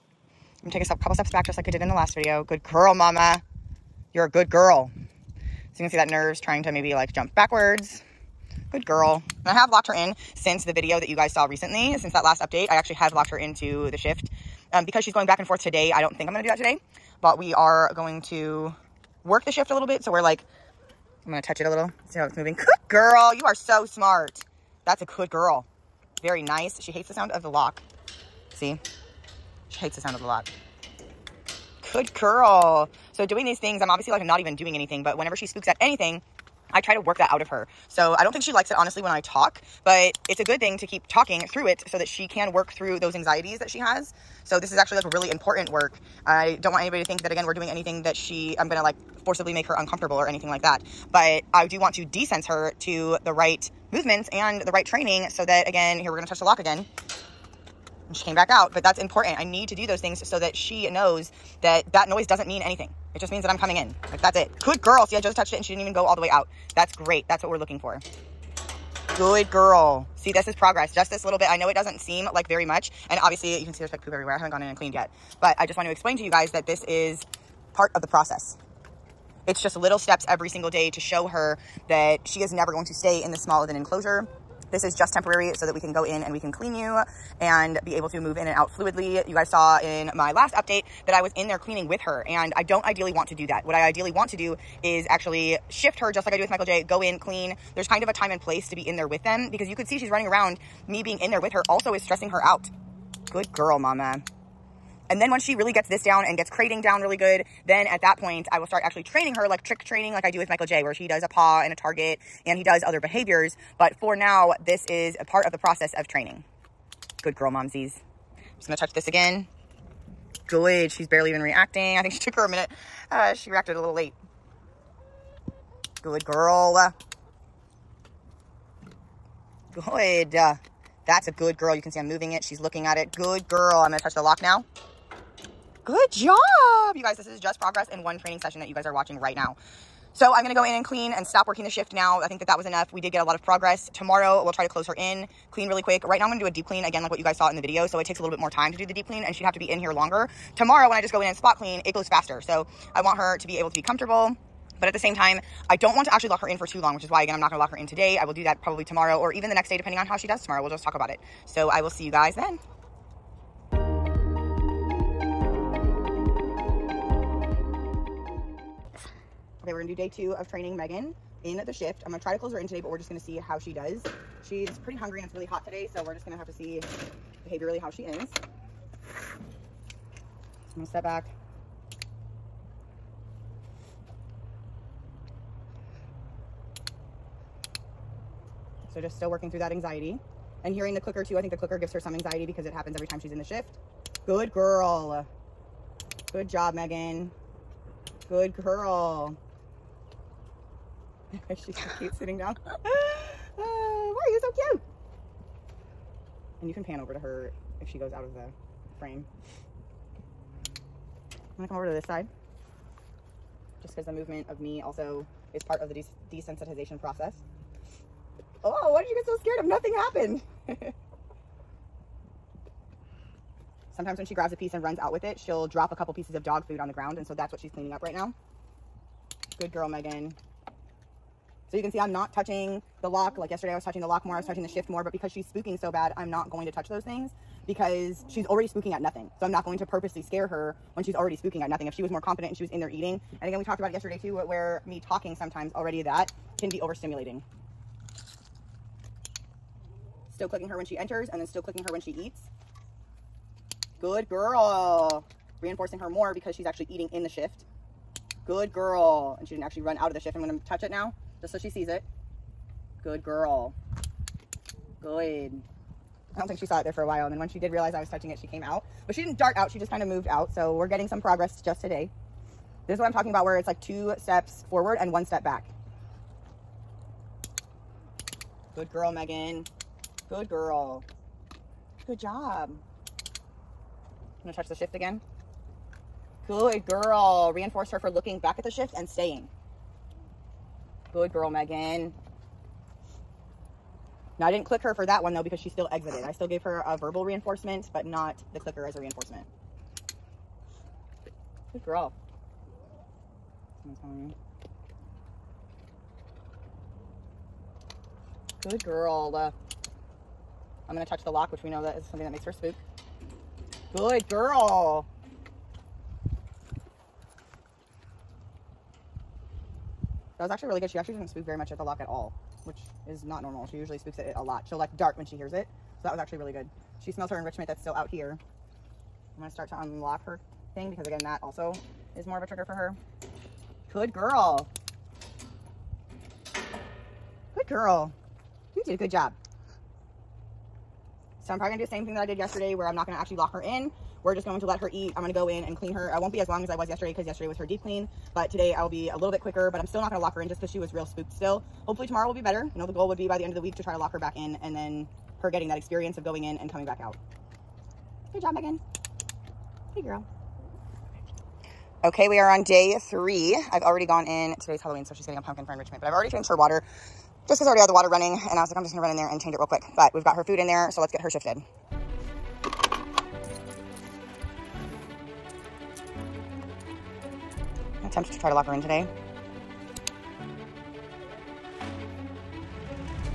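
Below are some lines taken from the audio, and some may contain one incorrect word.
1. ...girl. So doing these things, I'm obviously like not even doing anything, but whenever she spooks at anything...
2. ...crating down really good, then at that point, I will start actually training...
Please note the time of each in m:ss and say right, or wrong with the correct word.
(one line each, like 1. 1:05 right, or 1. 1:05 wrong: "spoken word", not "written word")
1. 0:32 right
2. 1:46 right.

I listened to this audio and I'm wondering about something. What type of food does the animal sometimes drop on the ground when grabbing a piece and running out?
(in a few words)
Dog food.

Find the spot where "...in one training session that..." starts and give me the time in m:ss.
2:17.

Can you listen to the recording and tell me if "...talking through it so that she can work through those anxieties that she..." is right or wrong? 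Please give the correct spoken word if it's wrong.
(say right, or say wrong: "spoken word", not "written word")
right.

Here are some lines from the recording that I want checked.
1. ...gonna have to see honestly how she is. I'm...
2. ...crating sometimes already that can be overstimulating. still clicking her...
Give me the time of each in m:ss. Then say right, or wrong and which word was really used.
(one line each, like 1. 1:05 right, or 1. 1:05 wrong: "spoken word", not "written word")
1. 2:56 wrong: "behaviorally", not "honestly"
2. 4:05 wrong: "talking", not "crating".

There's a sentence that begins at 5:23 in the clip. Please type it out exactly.
She usually spooks at it a lot.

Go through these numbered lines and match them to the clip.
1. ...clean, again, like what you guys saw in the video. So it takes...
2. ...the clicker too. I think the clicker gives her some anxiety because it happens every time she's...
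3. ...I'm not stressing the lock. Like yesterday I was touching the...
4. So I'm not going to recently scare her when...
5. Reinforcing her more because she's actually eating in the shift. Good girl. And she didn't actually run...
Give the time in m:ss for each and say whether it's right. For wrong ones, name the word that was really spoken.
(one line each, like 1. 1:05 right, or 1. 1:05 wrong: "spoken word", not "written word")
1. 2:26 right
2. 3:10 right
3. 3:51 wrong: "touching", not "stressing"
4. 3:59 wrong: "purposely", not "recently"
5. 4:15 right.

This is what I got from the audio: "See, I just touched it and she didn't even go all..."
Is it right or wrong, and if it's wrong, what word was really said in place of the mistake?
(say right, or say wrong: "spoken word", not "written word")
right.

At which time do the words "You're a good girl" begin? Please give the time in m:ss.
0:04.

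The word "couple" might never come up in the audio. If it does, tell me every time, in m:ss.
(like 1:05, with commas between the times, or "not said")
0:00, 3:45.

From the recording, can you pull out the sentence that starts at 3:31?
I'm gonna come over to this side just because the movement of me also is part of the des desensitization process.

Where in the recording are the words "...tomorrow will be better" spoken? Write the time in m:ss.
5:52.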